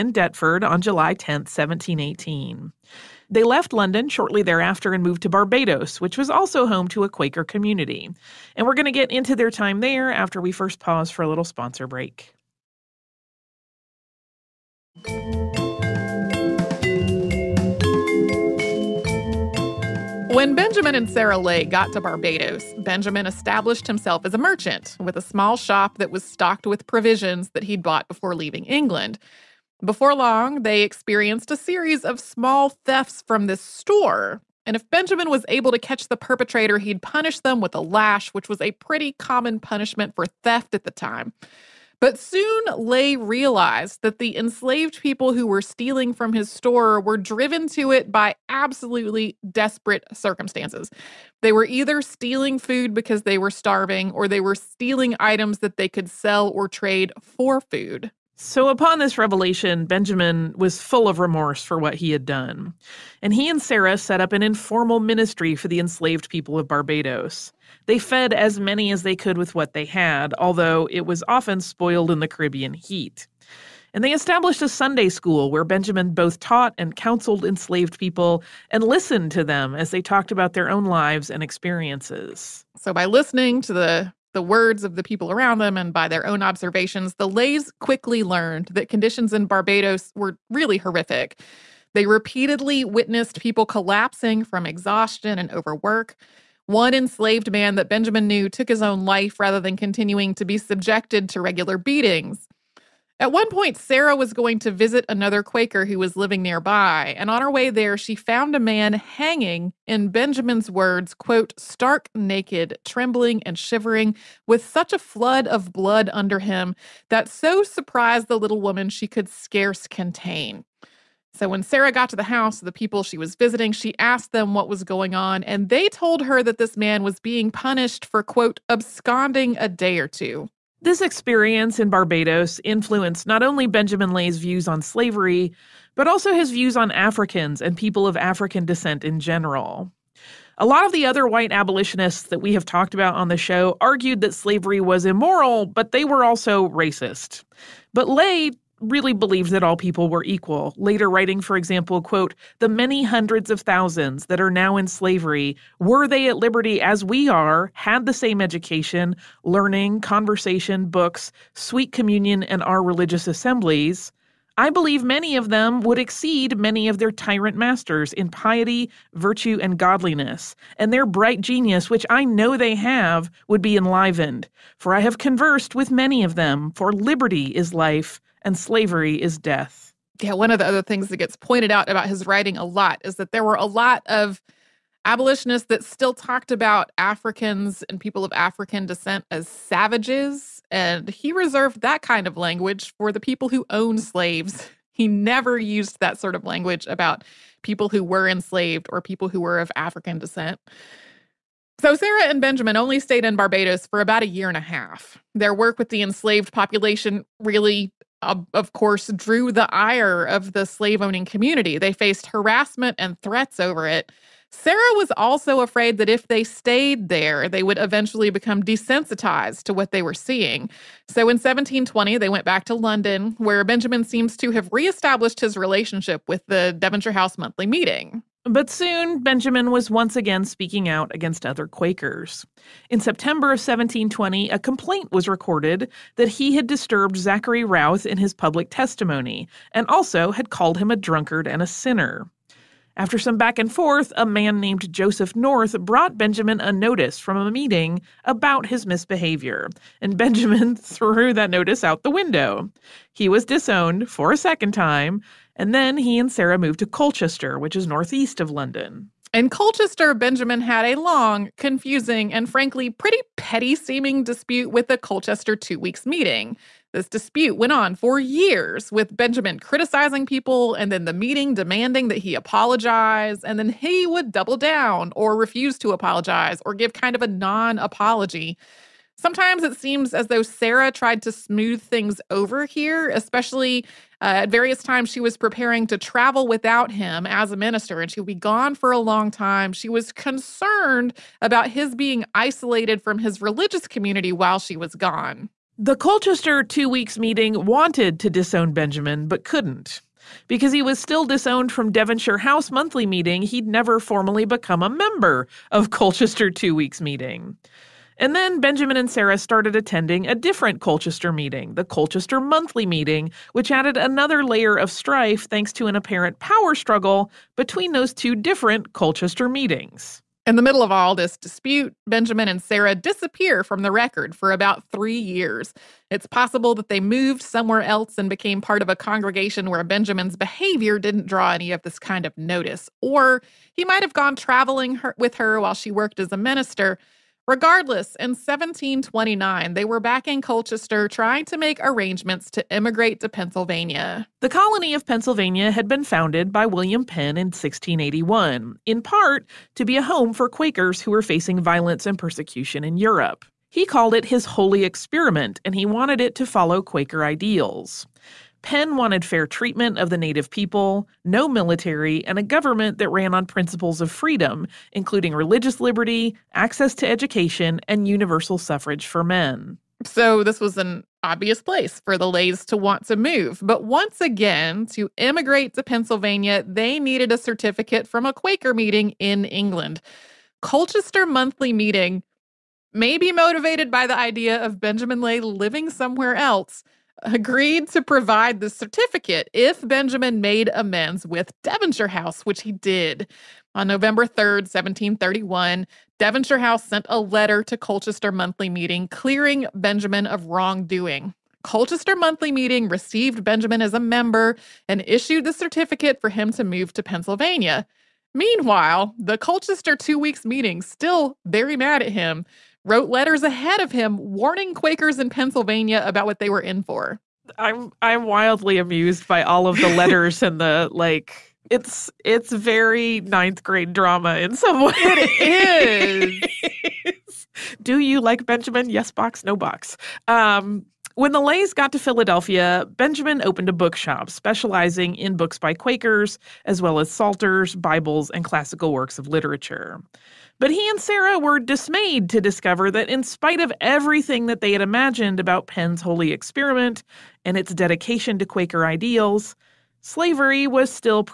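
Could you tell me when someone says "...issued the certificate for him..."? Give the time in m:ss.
6:45.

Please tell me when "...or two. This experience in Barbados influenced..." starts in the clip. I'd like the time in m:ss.
2:10.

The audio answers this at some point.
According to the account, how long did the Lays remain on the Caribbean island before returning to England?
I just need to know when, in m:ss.
3:24.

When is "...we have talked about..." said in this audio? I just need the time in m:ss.
2:22.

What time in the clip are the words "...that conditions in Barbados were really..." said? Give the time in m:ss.
1:28.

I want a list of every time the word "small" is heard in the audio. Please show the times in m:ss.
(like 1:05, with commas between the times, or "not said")
0:25, 0:32.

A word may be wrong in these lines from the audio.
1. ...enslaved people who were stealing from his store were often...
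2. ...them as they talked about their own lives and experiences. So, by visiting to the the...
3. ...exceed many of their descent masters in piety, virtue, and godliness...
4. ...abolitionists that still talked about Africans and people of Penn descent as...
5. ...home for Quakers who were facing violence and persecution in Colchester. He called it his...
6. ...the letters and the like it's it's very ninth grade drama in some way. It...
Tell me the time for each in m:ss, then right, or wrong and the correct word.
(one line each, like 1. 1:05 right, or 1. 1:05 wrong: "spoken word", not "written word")
1. 0:44 wrong: "driven", not "often"
2. 1:19 wrong: "listening", not "visiting"
3. 2:45 wrong: "tyrant", not "descent"
4. 3:05 wrong: "African", not "Penn"
5. 5:50 wrong: "Europe", not "Colchester"
6. 6:59 right.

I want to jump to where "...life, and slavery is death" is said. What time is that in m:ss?
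2:57.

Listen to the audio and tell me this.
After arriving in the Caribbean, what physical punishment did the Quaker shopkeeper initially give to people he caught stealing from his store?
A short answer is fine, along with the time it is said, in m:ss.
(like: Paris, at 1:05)
A lash, at 0:37.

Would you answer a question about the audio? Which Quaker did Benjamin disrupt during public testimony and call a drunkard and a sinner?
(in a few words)
Zachary Routh.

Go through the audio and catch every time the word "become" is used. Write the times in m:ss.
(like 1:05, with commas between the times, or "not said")
3:38, 5:04.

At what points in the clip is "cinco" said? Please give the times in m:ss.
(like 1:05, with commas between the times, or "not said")
not said.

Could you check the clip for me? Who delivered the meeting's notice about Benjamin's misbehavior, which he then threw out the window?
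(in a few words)
Joseph North.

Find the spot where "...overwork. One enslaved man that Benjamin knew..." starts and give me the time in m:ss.
1:35.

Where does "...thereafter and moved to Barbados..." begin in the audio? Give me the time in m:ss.
0:04.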